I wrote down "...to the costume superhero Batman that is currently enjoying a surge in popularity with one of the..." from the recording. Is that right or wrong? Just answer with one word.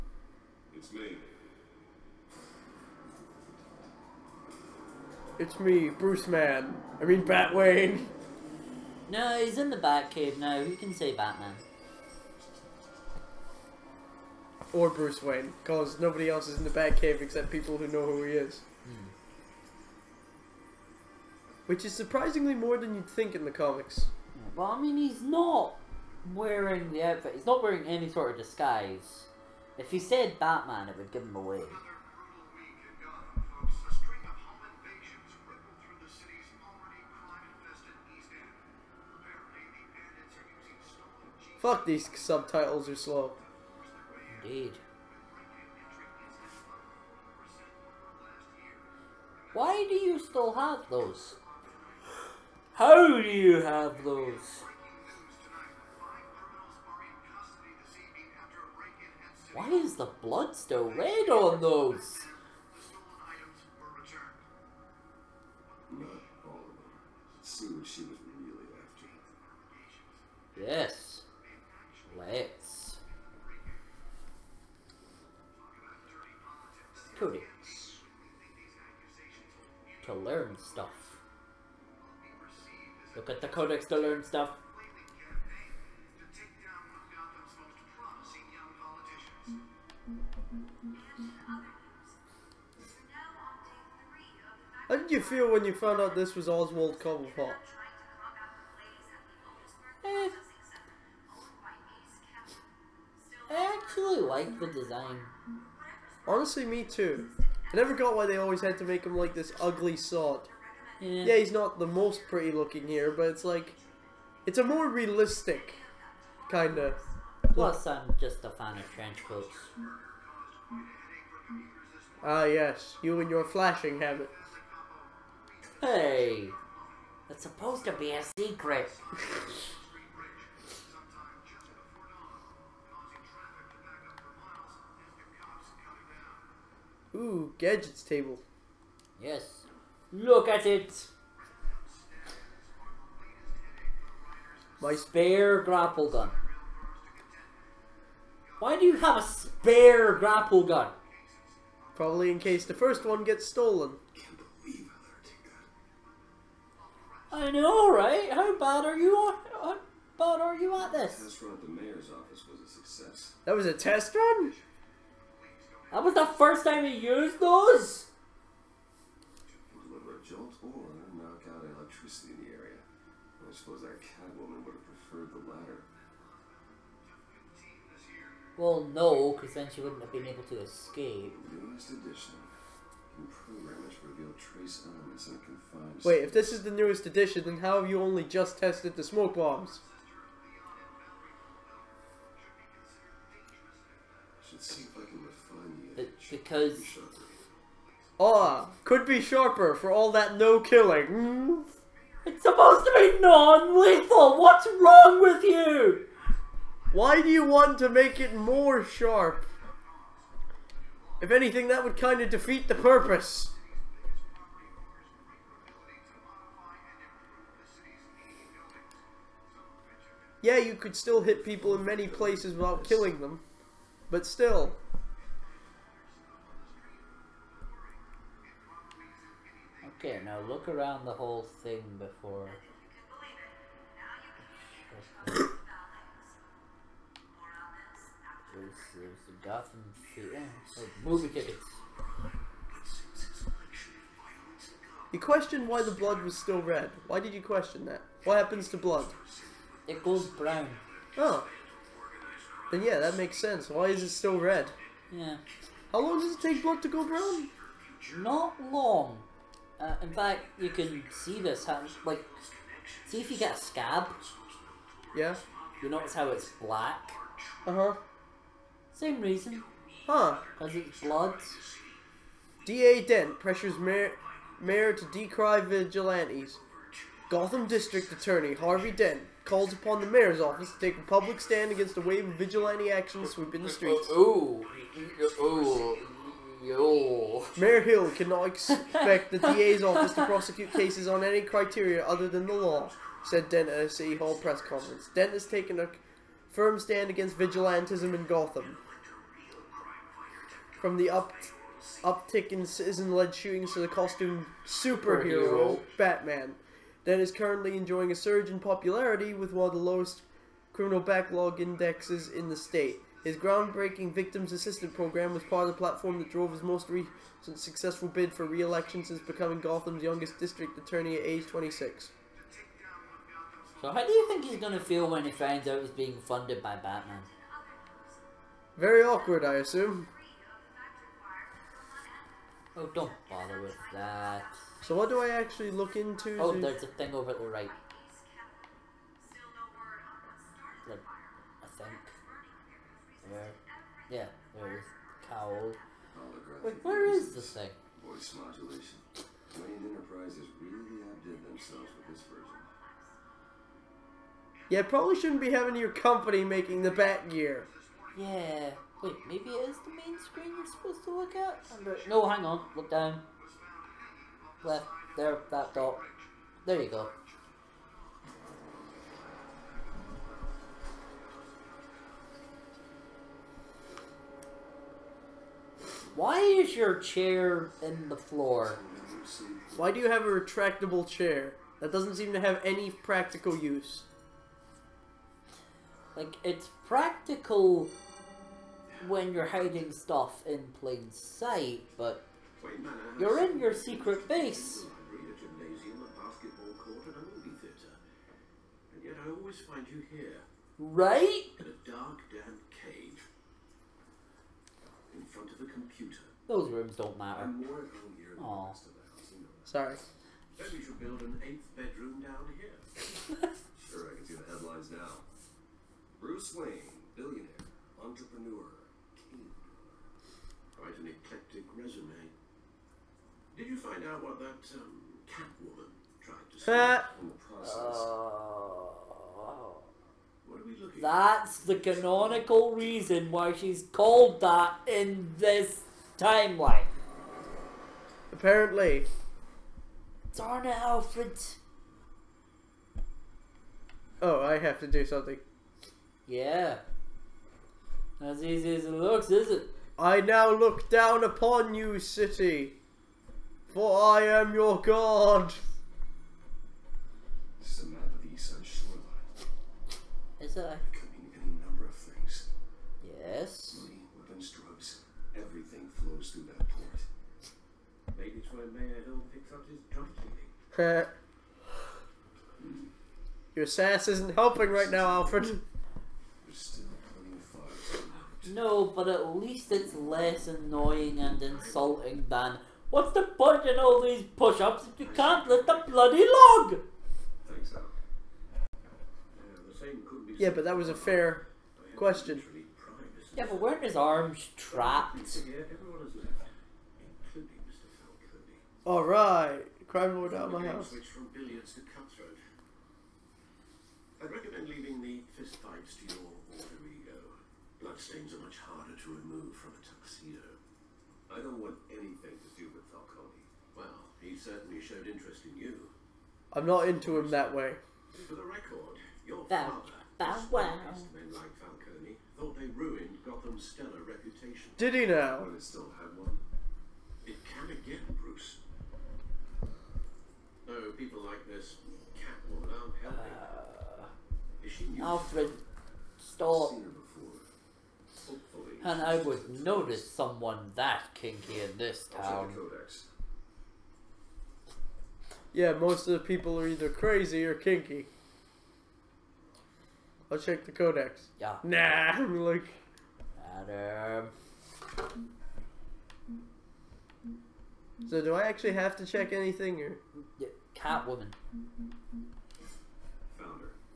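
right.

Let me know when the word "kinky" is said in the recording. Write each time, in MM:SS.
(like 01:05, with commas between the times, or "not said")
09:01, 09:07.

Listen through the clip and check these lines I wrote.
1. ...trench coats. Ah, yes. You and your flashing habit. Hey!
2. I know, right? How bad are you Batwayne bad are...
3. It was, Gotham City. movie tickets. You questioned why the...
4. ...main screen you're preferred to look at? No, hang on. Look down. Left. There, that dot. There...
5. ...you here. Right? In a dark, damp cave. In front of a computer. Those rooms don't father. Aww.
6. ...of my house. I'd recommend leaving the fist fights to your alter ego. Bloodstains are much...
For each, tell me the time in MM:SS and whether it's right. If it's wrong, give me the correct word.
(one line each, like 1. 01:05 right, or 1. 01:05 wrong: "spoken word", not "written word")
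1. 01:58 right
2. 02:37 wrong: "How", not "Batwayne"
3. 03:58 right
4. 05:59 wrong: "supposed", not "preferred"
5. 06:39 wrong: "matter", not "father"
6. 08:20 right.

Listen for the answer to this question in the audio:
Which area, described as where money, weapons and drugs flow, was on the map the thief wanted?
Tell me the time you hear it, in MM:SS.
07:38.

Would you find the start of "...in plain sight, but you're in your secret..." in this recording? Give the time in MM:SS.
06:30.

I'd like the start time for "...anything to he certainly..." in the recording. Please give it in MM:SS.
08:31.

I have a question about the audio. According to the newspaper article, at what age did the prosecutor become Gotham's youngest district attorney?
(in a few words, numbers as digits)
26.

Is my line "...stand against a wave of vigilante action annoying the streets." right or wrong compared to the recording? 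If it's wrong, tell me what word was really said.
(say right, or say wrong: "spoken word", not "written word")
wrong: "sweeping", not "annoying".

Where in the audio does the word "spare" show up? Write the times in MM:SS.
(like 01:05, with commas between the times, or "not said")
02:24, 02:29.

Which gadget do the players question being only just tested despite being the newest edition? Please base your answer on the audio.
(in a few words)
smoke bombs.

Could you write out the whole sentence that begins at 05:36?
Oh, there's a thing over at the right.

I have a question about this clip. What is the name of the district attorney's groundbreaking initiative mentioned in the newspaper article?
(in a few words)
Victims Assistance Program.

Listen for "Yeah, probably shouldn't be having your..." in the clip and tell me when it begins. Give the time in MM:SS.
05:54.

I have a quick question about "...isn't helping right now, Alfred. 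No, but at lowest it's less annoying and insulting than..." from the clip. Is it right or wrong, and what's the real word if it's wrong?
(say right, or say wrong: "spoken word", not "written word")
wrong: "least", not "lowest".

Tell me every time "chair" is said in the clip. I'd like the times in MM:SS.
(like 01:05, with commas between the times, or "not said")
06:17, 06:21.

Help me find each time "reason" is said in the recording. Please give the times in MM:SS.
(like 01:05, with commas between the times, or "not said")
04:29, 07:12.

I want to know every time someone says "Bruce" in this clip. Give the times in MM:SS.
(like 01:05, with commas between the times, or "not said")
00:05, 00:14, 08:48.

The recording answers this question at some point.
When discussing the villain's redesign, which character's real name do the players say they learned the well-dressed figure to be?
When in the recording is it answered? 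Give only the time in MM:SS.
01:36.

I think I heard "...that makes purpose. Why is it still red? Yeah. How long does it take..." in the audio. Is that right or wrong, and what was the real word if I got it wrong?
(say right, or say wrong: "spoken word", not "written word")
wrong: "sense", not "purpose".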